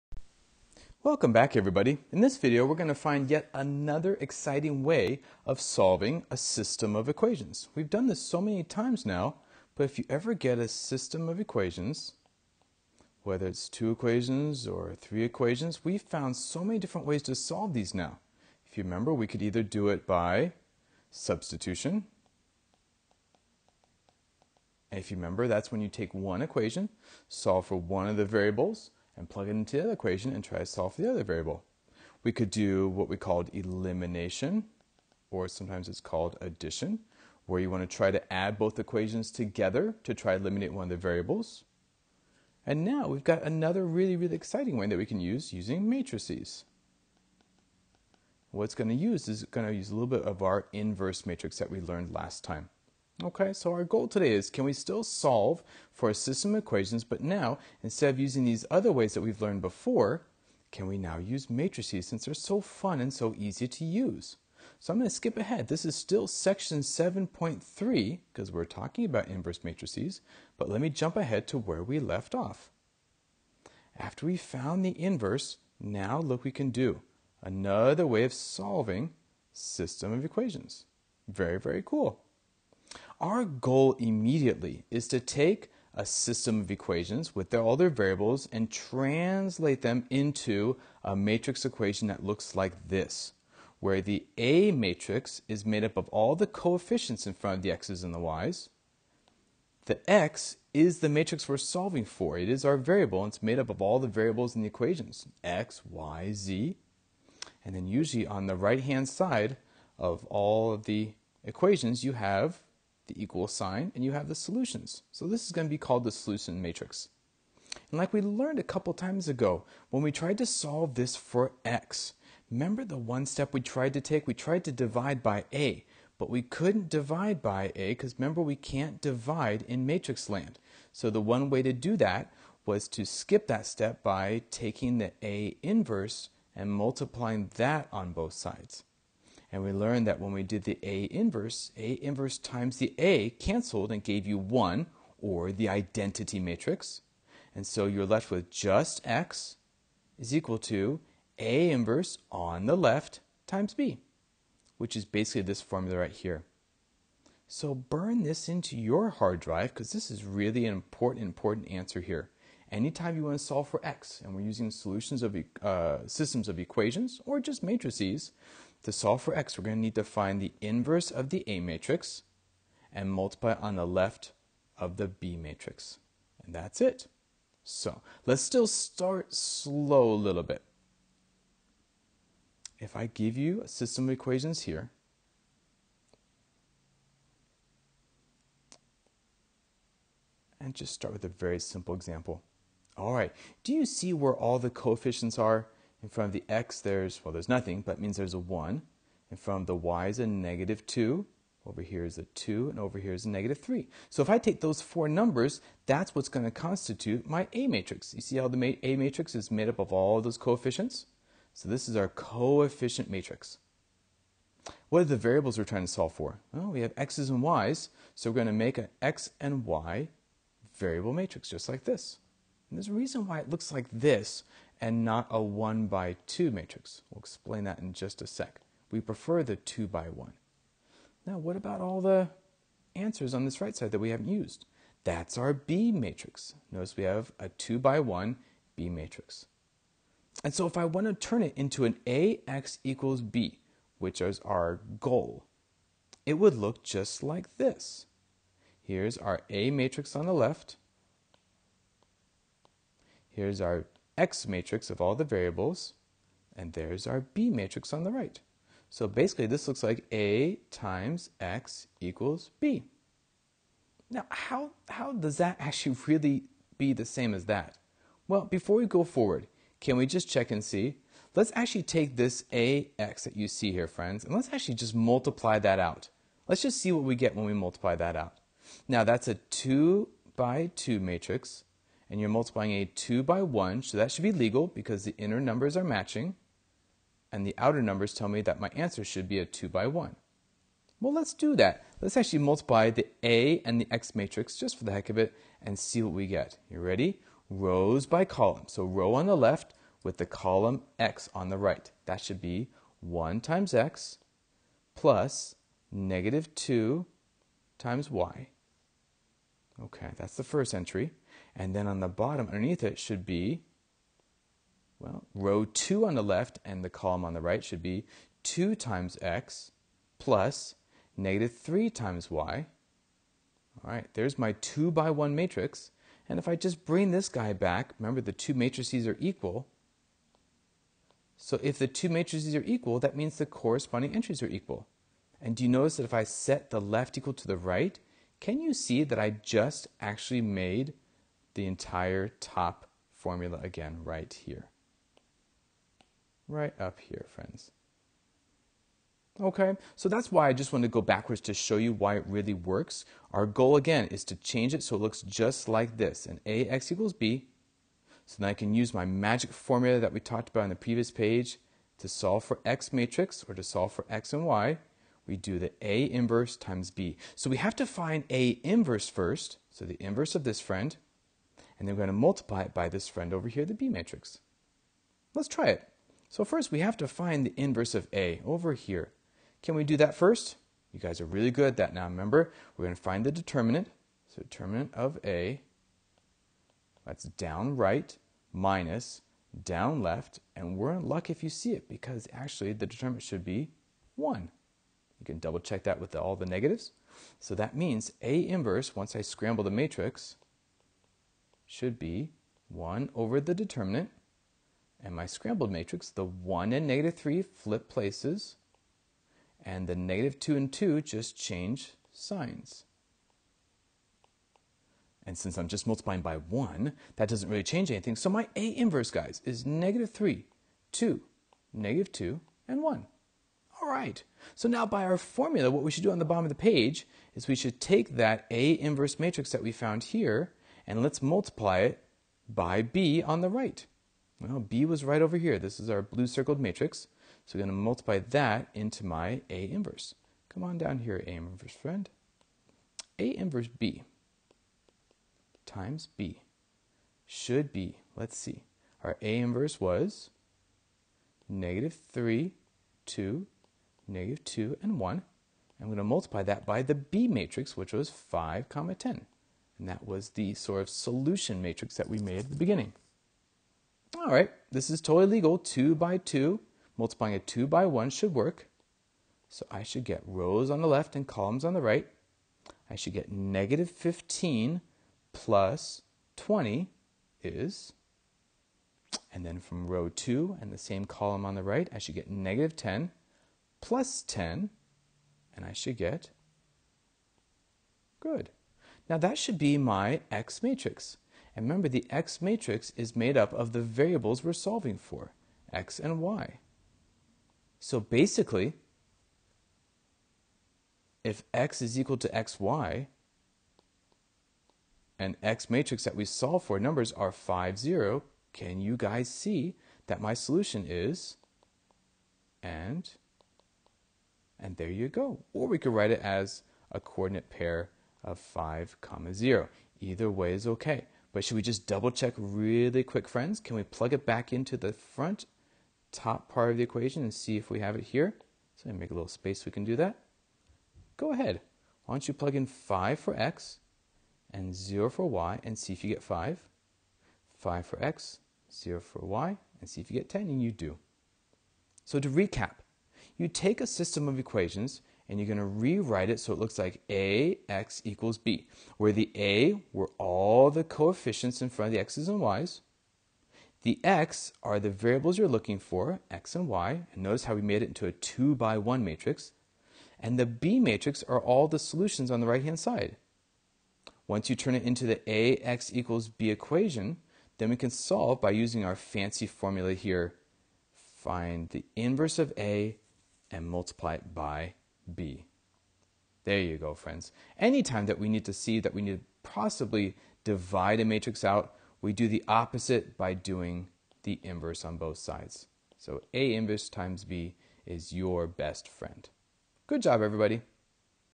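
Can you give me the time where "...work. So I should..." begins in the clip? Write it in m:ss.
7:48.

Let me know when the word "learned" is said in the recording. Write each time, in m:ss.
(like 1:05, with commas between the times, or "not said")
0:51, 0:59, 1:58, 2:19.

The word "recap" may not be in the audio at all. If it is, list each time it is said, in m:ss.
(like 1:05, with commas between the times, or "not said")
9:02.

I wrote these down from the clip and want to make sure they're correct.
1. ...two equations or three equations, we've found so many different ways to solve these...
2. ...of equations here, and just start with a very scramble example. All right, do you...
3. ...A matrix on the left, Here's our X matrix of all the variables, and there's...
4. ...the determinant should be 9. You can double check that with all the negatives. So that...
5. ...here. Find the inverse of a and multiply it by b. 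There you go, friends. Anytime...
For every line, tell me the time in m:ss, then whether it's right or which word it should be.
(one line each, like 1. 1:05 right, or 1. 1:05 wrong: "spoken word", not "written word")
1. 0:13 right
2. 3:04 wrong: "simple", not "scramble"
3. 4:09 right
4. 6:32 wrong: "1", not "9"
5. 9:29 right.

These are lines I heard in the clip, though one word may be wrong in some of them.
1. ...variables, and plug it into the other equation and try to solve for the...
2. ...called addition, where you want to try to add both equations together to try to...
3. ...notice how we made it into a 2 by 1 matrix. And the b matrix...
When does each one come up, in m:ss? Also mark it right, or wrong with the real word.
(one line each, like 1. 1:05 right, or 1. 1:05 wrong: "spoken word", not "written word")
1. 0:28 right
2. 0:36 right
3. 9:17 right.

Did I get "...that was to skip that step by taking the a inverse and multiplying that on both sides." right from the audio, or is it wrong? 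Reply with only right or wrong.
right.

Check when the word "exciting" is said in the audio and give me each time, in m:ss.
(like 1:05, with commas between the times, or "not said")
0:04, 0:44.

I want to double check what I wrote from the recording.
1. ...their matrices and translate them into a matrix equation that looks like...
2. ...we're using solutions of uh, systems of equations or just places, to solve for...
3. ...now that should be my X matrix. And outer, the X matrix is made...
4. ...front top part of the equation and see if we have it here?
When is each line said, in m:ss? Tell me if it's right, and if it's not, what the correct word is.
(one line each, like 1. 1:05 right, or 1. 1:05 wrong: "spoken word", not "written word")
1. 1:27 wrong: "variables", not "matrices"
2. 2:44 wrong: "matrices", not "places"
3. 8:09 wrong: "remember", not "outer"
4. 8:44 right.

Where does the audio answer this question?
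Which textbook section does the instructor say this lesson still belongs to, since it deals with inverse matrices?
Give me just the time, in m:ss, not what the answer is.
1:06.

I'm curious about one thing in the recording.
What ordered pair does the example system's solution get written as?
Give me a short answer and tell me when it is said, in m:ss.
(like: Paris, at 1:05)
(5, 0), at 8:38.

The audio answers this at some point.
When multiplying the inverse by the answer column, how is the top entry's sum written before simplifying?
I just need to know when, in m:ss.
7:53.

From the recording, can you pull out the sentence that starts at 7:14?
Well, b was right over here.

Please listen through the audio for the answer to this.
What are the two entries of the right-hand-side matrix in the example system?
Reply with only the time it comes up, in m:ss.
7:38.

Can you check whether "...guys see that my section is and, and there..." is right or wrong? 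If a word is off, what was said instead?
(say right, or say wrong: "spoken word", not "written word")
wrong: "solution", not "section".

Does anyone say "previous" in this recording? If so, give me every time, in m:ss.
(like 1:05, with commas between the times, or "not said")
6:00.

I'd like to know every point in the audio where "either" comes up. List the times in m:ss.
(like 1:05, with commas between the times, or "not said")
0:19, 8:39.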